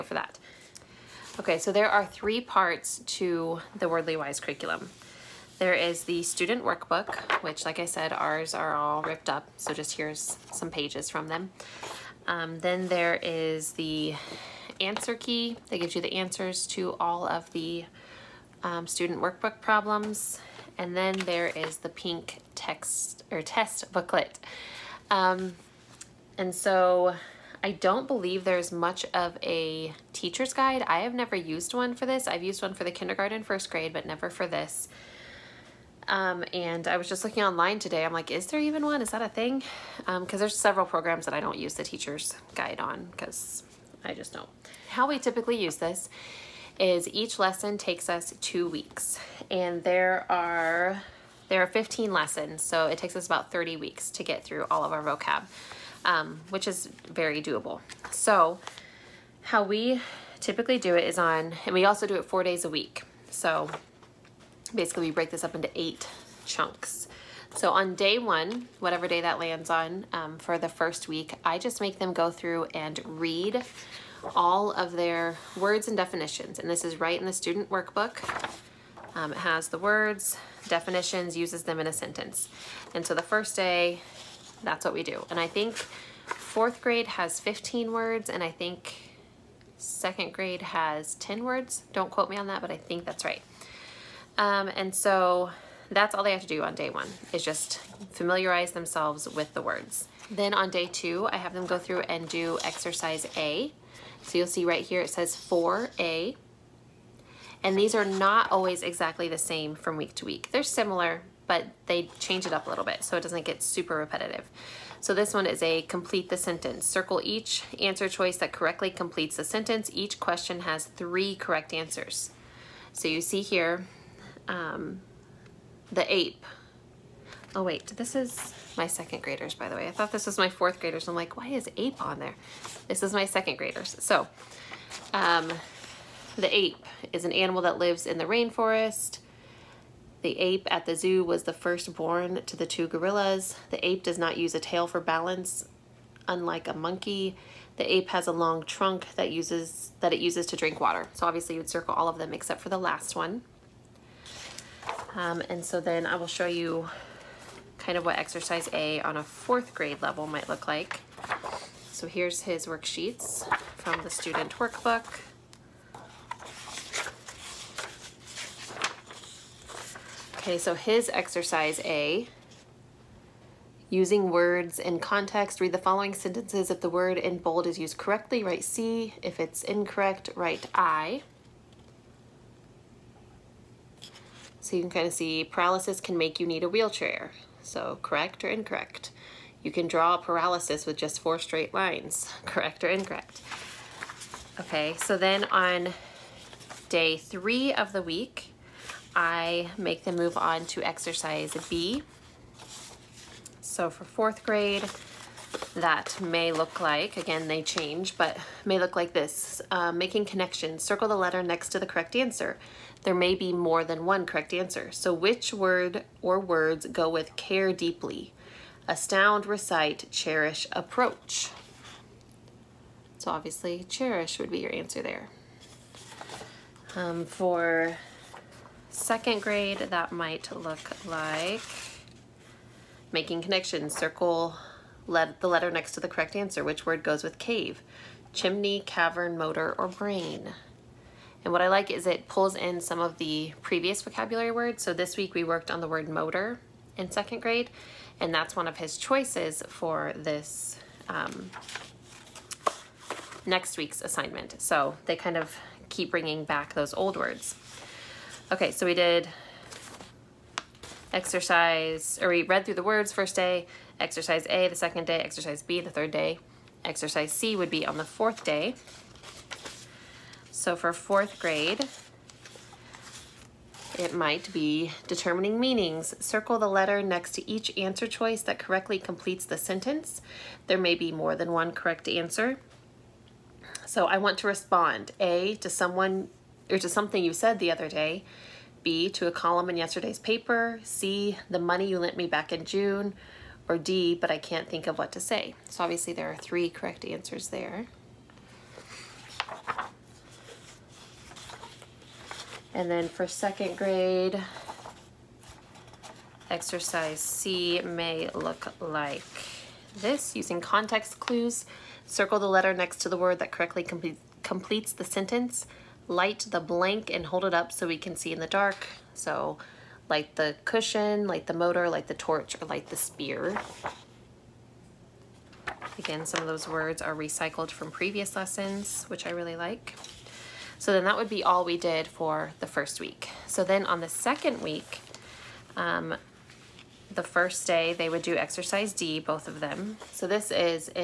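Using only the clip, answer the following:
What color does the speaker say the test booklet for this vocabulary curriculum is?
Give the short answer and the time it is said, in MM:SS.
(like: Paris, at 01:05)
Pink, at 00:21.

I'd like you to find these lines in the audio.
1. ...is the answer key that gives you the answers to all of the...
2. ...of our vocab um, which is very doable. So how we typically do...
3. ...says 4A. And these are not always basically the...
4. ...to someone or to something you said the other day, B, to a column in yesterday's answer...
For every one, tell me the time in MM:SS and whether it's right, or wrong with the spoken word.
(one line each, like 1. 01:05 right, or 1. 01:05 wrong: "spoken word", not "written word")
1. 00:13 right
2. 00:54 right
3. 01:45 wrong: "exactly", not "basically"
4. 04:45 wrong: "paper", not "answer".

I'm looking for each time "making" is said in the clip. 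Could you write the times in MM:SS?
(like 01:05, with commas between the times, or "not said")
03:29, 03:53.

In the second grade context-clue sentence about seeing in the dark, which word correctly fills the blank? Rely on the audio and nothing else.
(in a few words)
Torch.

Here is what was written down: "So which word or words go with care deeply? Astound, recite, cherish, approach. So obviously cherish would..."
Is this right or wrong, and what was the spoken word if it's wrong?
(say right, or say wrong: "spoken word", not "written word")
right.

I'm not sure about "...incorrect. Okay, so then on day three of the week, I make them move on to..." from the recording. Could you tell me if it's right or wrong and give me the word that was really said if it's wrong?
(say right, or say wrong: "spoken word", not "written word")
right.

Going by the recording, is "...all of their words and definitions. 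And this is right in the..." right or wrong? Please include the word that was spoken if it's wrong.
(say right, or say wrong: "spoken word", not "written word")
right.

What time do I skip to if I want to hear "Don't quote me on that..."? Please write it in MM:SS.
01:31.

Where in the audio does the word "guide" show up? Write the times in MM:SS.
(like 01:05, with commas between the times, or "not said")
00:30, 00:42.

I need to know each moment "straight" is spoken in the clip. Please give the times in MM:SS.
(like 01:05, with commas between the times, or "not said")
03:11.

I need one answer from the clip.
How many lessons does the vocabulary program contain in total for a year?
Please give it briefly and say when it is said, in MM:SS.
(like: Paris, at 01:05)
15, at 00:51.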